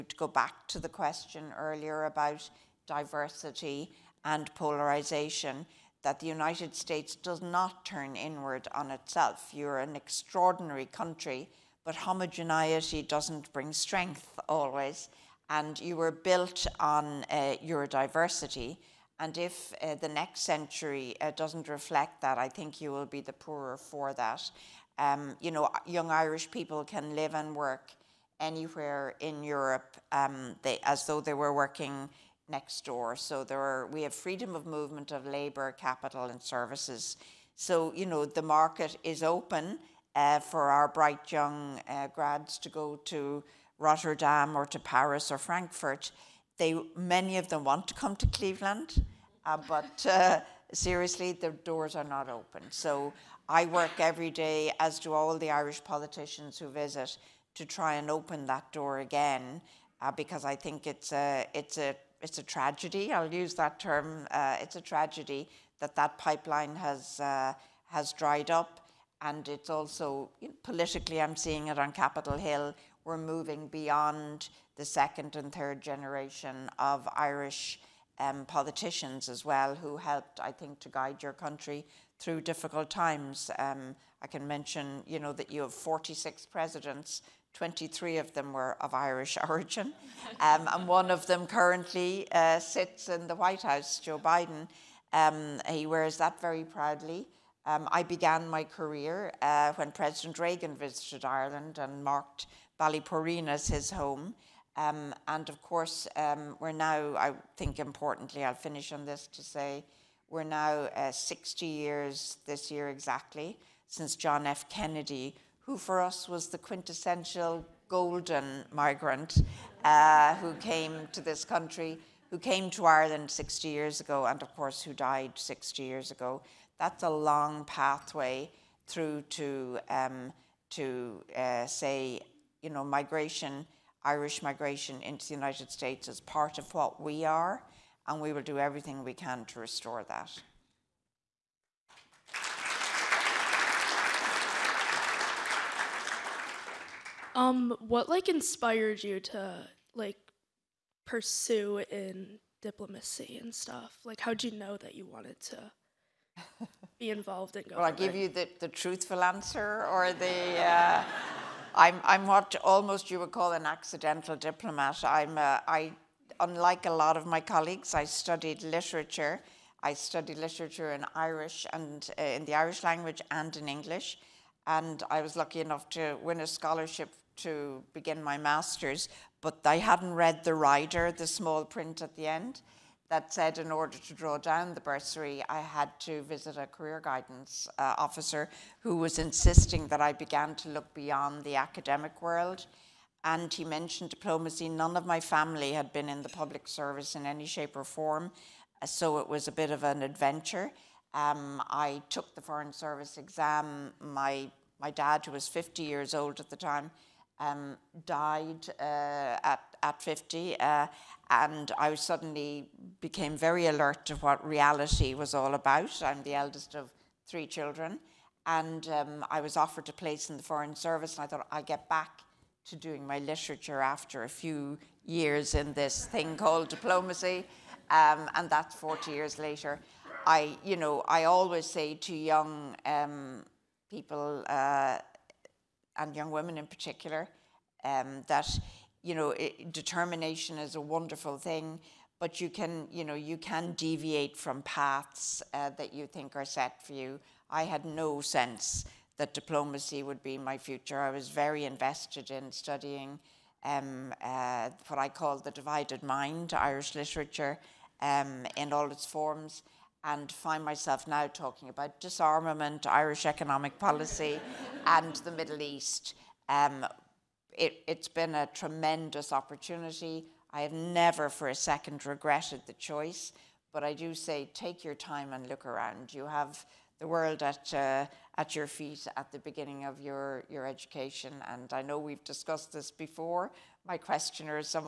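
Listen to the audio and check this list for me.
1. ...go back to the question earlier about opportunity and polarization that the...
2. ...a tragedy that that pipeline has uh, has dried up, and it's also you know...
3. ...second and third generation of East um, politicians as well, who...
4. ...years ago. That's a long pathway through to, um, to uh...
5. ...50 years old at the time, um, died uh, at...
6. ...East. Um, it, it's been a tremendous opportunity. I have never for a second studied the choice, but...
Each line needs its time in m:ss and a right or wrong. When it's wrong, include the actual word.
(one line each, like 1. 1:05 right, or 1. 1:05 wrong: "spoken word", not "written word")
1. 0:00 wrong: "diversity", not "opportunity"
2. 1:04 right
3. 1:14 wrong: "Irish", not "East"
4. 2:05 right
5. 3:25 right
6. 4:25 wrong: "regretted", not "studied".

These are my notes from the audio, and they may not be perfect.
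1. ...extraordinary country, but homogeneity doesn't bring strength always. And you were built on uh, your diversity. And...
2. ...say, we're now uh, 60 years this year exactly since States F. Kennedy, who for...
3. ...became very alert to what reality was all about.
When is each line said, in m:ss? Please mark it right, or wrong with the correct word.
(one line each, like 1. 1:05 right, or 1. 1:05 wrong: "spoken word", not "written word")
1. 0:09 right
2. 1:49 wrong: "John", not "States"
3. 3:33 right.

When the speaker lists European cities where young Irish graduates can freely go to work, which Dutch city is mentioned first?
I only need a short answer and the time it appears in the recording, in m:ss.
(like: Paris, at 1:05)
Rotterdam, at 0:43.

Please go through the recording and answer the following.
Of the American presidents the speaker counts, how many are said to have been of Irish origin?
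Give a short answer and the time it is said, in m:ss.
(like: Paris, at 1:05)
23, at 1:27.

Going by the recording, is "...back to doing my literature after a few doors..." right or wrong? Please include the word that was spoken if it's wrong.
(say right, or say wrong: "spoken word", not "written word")
wrong: "years", not "doors".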